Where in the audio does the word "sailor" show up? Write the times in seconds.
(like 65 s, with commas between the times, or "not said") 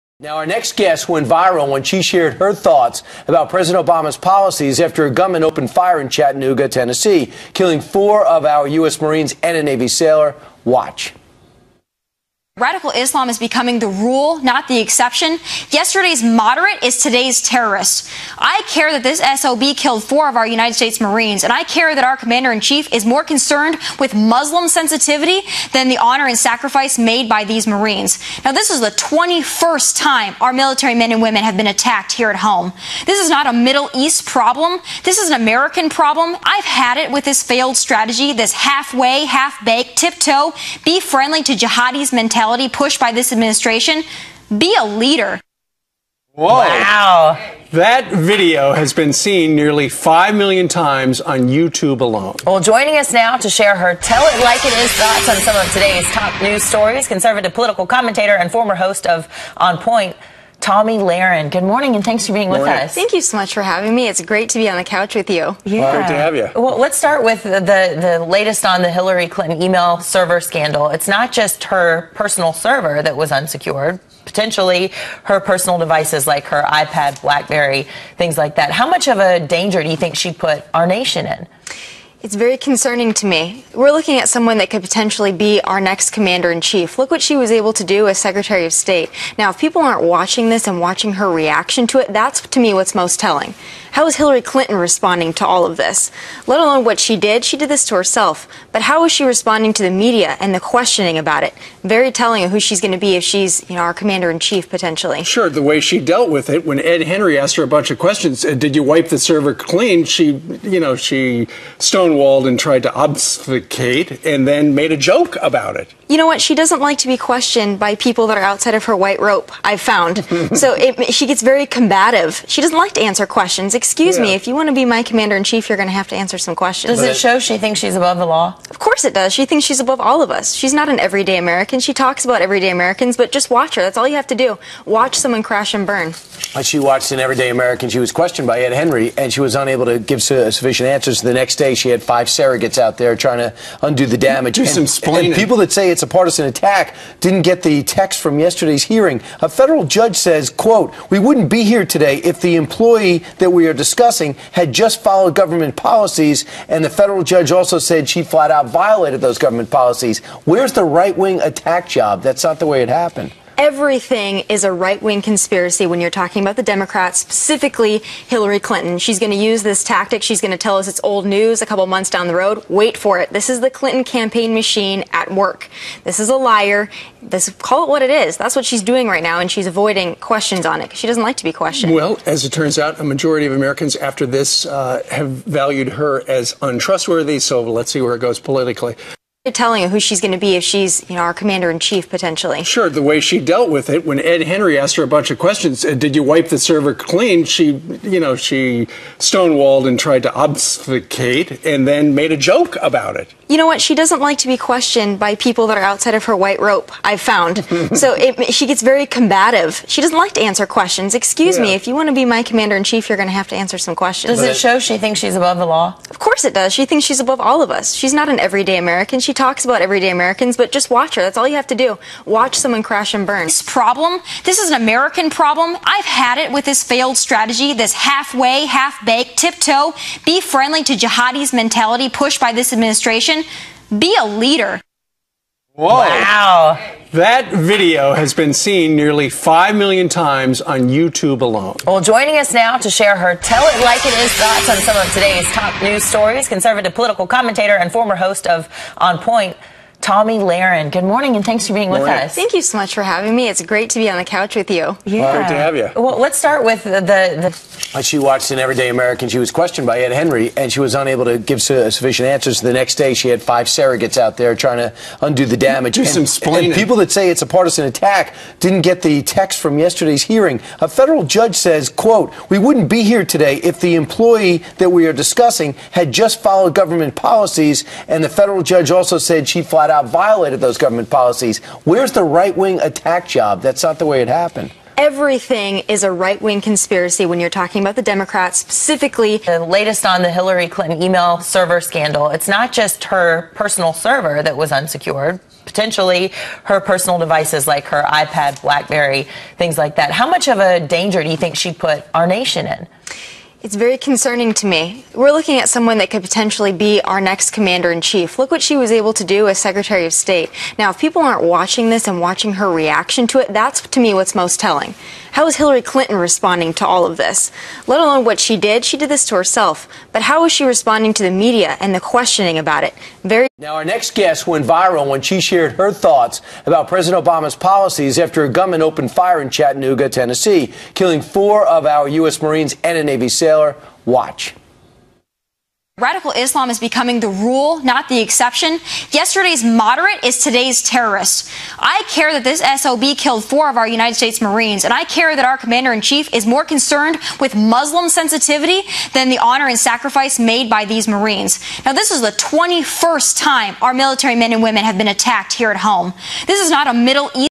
9 s, 333 s.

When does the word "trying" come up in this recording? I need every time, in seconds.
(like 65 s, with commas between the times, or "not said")
143 s, 264 s.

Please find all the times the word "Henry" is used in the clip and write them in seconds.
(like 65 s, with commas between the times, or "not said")
107 s, 138 s, 194 s, 260 s.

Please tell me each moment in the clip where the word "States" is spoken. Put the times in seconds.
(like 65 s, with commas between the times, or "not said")
20 s, 88 s, 310 s, 344 s.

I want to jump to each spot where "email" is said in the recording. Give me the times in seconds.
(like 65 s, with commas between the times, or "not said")
69 s, 291 s.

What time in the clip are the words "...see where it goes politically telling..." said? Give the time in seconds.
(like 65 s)
187 s.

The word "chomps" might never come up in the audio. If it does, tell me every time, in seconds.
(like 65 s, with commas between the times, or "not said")
not said.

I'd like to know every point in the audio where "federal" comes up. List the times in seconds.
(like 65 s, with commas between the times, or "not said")
149 s, 156 s, 270 s, 278 s.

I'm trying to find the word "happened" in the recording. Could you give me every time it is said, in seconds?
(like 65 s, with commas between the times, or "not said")
162 s, 284 s.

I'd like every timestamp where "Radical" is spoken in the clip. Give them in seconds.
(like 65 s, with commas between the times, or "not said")
12 s, 335 s.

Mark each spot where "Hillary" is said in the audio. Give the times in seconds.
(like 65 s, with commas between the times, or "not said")
68 s, 94 s, 168 s, 290 s, 315 s.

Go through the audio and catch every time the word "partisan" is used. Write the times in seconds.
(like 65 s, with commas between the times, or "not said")
146 s, 267 s.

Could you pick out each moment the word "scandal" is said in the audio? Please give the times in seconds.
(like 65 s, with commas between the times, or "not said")
70 s, 291 s.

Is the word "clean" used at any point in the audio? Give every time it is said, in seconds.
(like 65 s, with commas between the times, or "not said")
109 s, 196 s.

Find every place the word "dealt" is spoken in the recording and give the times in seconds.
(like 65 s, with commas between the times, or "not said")
105 s, 193 s.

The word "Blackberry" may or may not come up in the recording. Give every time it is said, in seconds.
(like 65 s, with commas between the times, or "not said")
77 s, 298 s.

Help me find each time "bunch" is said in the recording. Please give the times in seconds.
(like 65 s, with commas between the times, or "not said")
107 s, 195 s.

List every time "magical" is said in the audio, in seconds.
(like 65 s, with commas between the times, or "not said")
not said.